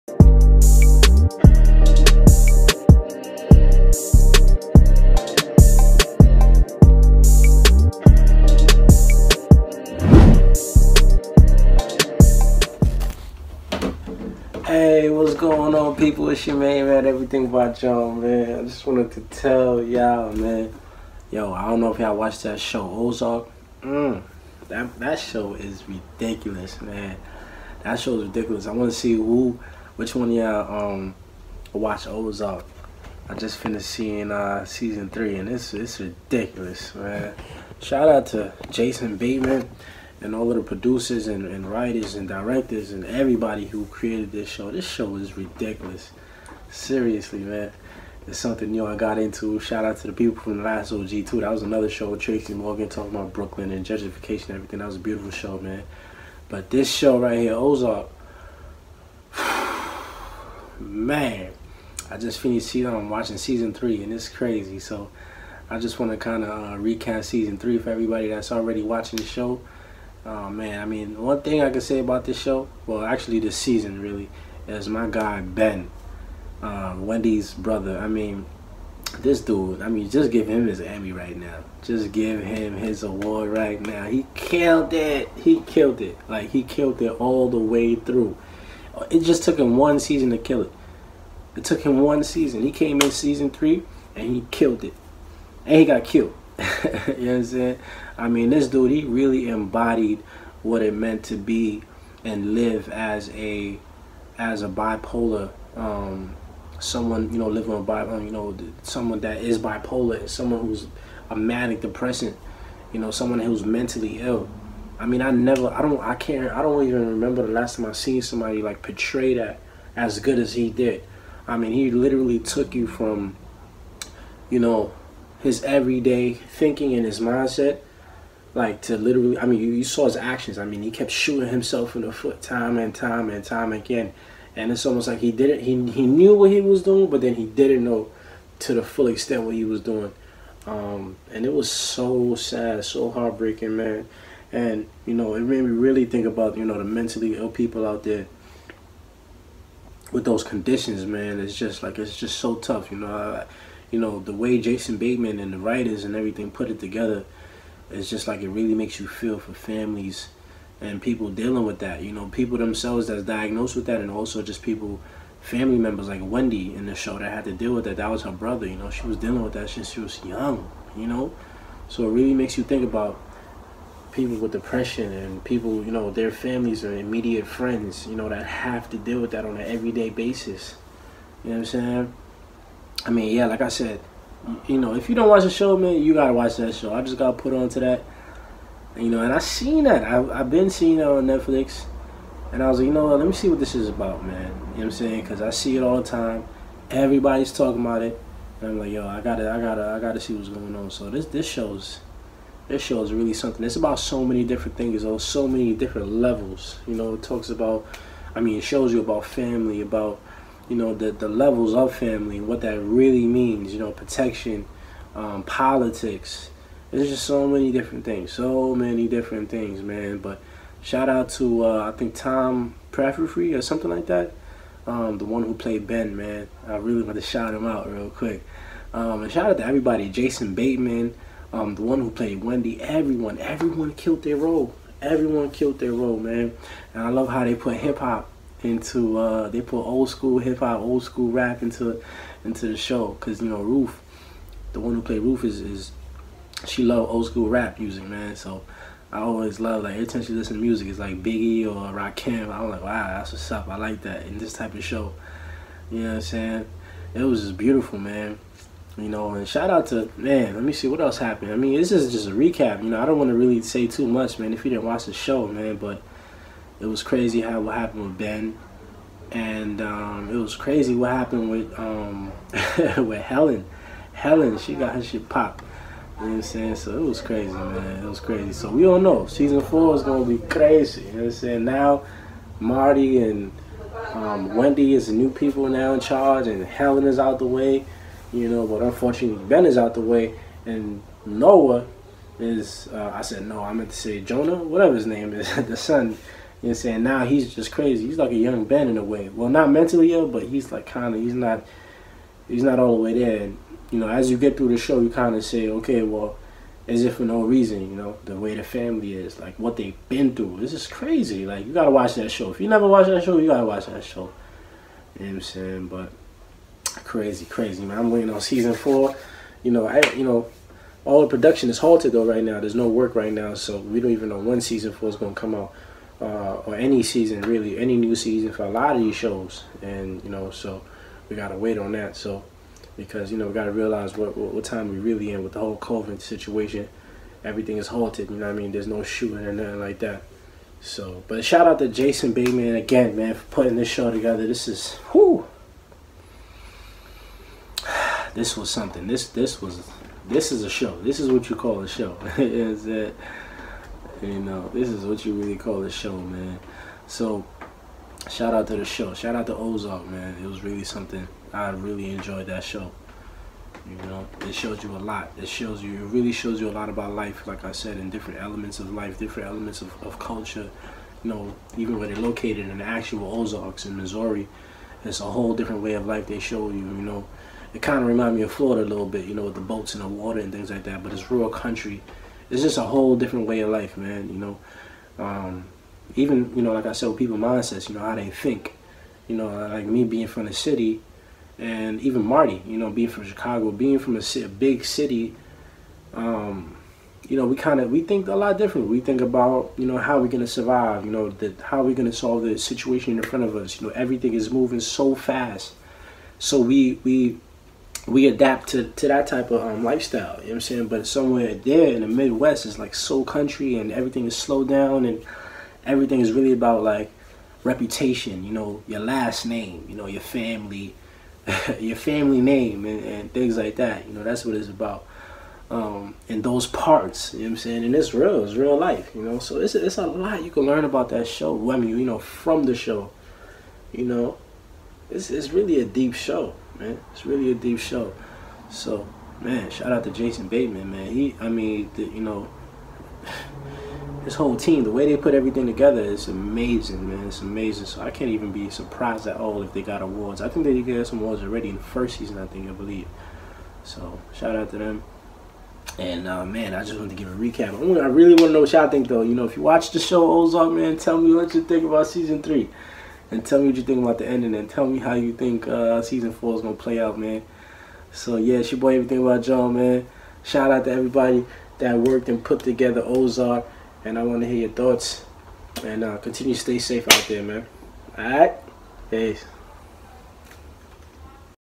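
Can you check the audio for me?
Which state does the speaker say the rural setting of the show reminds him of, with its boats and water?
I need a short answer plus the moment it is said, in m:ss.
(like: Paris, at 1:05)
Florida, at 6:18.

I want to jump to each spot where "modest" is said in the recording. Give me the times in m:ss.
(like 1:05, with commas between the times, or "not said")
not said.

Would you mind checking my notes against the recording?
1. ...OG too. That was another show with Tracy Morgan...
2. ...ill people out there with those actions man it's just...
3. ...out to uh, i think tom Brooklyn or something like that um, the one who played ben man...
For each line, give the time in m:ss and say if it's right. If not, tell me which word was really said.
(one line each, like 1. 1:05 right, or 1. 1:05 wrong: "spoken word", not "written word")
1. 0:50 right
2. 2:27 wrong: "conditions", not "actions"
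3. 3:41 wrong: "Praffery", not "Brooklyn".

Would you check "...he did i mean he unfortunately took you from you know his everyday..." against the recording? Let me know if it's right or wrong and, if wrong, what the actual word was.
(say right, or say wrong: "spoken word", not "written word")
wrong: "literally", not "unfortunately".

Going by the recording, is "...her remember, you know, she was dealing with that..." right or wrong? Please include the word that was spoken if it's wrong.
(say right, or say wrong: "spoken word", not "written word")
wrong: "brother", not "remember".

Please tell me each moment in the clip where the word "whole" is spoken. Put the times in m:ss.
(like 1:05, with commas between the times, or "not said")
5:35, 6:15, 6:22, 7:24.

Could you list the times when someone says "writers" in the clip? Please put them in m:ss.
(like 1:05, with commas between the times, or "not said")
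0:41, 2:35.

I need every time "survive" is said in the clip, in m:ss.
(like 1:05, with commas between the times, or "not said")
6:40.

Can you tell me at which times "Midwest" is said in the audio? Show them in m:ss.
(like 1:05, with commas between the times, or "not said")
6:52.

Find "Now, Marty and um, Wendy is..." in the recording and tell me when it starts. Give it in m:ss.
4:41.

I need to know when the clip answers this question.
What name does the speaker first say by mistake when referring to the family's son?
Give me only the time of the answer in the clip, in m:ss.
4:51.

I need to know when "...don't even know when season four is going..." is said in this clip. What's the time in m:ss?
5:23.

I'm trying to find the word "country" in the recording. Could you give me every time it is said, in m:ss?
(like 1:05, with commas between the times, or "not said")
6:21, 6:53.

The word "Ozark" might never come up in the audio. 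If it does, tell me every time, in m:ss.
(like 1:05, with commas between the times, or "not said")
0:22, 0:32, 0:57, 5:59, 6:13, 7:40, 7:53.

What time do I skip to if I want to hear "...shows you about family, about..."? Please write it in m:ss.
3:28.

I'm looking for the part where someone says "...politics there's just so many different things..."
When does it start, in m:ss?
3:35.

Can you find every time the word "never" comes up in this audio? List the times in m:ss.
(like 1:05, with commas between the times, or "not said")
1:55, 5:12.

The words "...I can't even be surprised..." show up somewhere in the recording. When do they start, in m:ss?
7:28.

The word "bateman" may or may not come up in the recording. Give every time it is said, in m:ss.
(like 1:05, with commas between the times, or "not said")
0:39, 2:34, 3:50, 5:42, 7:20.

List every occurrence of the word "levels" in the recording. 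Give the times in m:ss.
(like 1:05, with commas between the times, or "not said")
3:26, 3:31.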